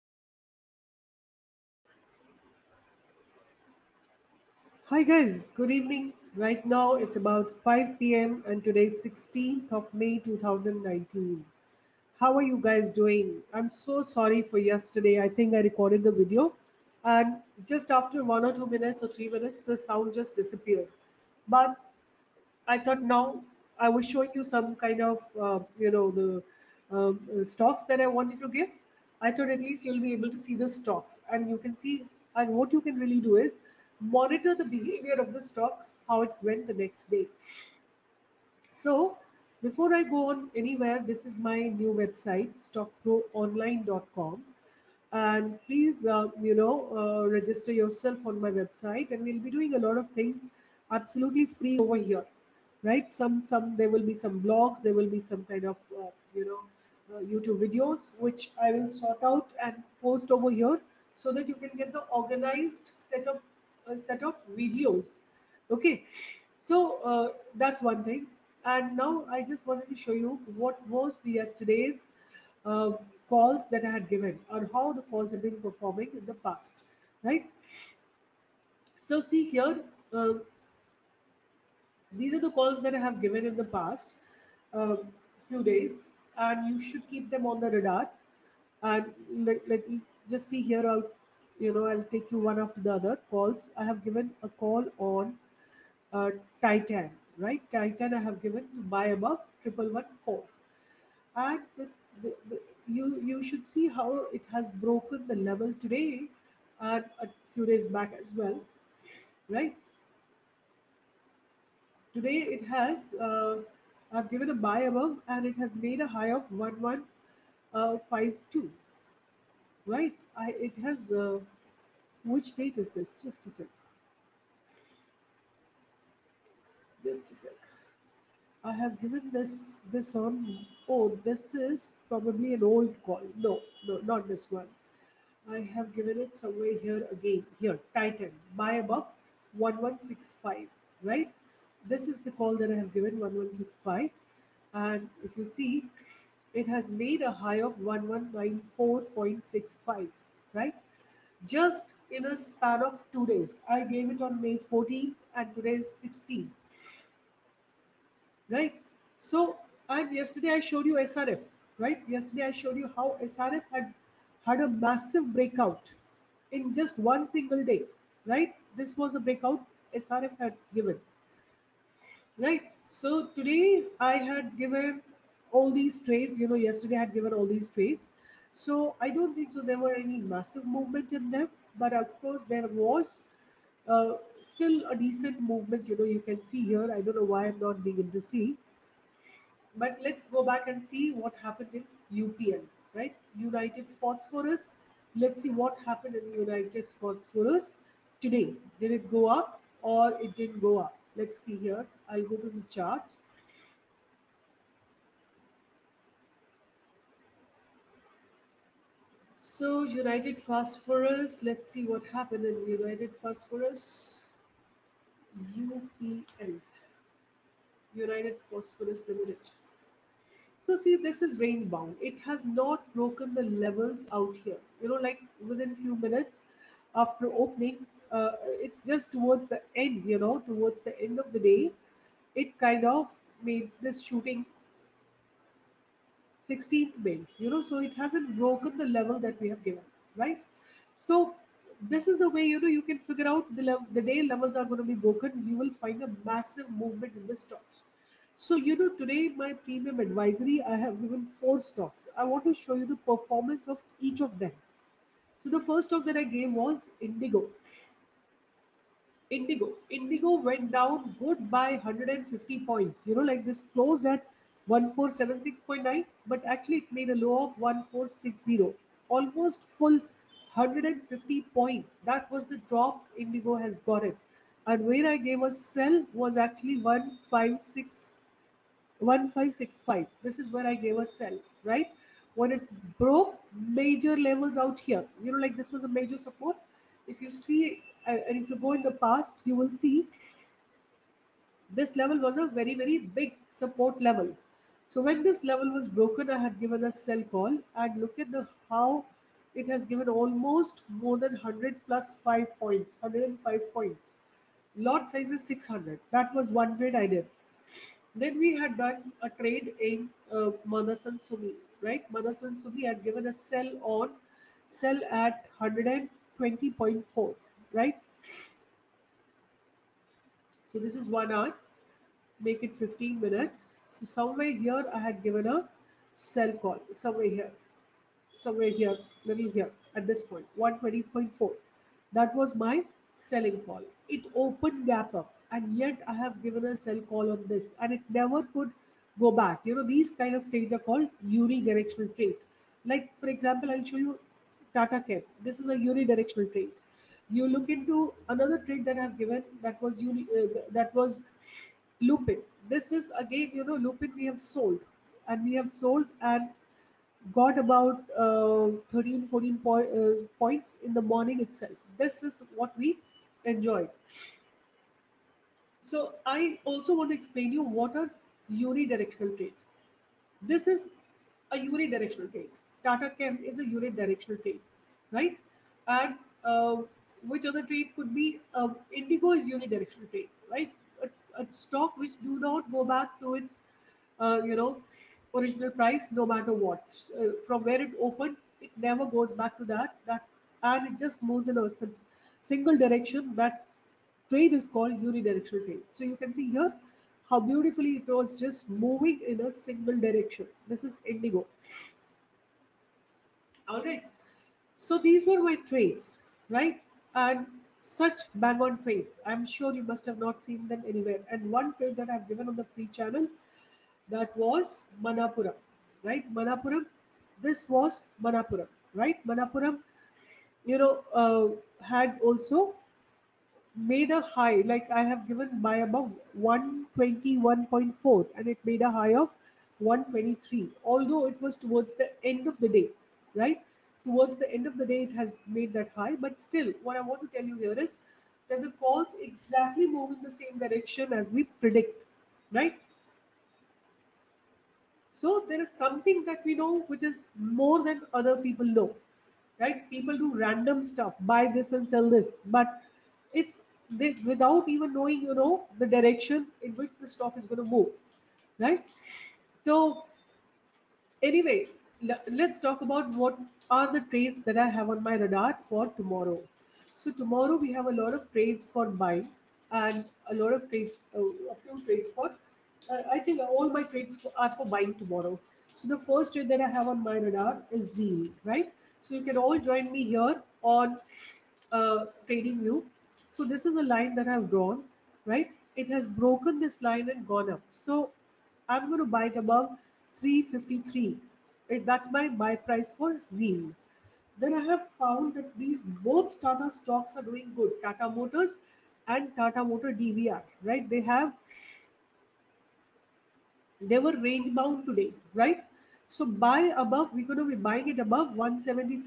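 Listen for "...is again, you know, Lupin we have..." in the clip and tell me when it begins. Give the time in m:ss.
5:52.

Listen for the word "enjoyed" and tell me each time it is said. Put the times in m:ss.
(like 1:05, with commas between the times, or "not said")
6:03.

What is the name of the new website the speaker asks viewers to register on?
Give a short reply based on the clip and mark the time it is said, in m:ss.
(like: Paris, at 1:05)
stockproonline.com, at 0:42.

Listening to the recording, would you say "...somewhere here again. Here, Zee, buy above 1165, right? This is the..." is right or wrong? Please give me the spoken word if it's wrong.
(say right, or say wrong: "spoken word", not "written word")
wrong: "Titan", not "Zee".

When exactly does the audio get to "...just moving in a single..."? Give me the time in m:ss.
6:38.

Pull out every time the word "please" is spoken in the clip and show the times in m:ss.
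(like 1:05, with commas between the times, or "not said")
0:45.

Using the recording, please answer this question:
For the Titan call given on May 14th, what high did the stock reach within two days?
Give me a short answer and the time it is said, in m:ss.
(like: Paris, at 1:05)
1194.65, at 2:27.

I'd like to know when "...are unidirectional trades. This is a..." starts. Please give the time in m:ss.
6:07.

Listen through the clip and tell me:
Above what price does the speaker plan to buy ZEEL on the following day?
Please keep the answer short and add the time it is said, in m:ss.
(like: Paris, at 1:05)
353, at 8:09.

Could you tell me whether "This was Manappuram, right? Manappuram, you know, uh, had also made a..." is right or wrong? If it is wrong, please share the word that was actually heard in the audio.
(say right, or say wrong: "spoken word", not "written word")
right.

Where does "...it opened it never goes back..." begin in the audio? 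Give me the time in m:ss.
6:27.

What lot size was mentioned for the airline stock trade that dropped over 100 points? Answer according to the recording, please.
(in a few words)
600.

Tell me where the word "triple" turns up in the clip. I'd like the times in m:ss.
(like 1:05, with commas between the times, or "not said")
1:39.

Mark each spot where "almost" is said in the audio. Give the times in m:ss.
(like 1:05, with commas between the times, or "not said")
4:29, 5:00.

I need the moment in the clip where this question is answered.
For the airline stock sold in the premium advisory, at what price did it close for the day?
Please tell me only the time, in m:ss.
4:24.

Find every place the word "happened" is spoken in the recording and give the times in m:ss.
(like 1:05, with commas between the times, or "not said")
3:11, 3:15, 3:32.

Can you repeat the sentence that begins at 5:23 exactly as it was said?
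So somewhere here, I had given a sell call, somewhere here, somewhere here, little here, at this point, 120.4.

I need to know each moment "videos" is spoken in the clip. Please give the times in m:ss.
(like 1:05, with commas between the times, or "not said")
0:16, 0:57, 1:04.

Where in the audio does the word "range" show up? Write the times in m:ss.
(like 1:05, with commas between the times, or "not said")
3:41, 8:24.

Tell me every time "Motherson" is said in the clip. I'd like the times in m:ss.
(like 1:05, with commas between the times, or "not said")
5:12.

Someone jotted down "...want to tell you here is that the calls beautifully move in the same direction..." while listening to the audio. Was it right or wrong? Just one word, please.
wrong.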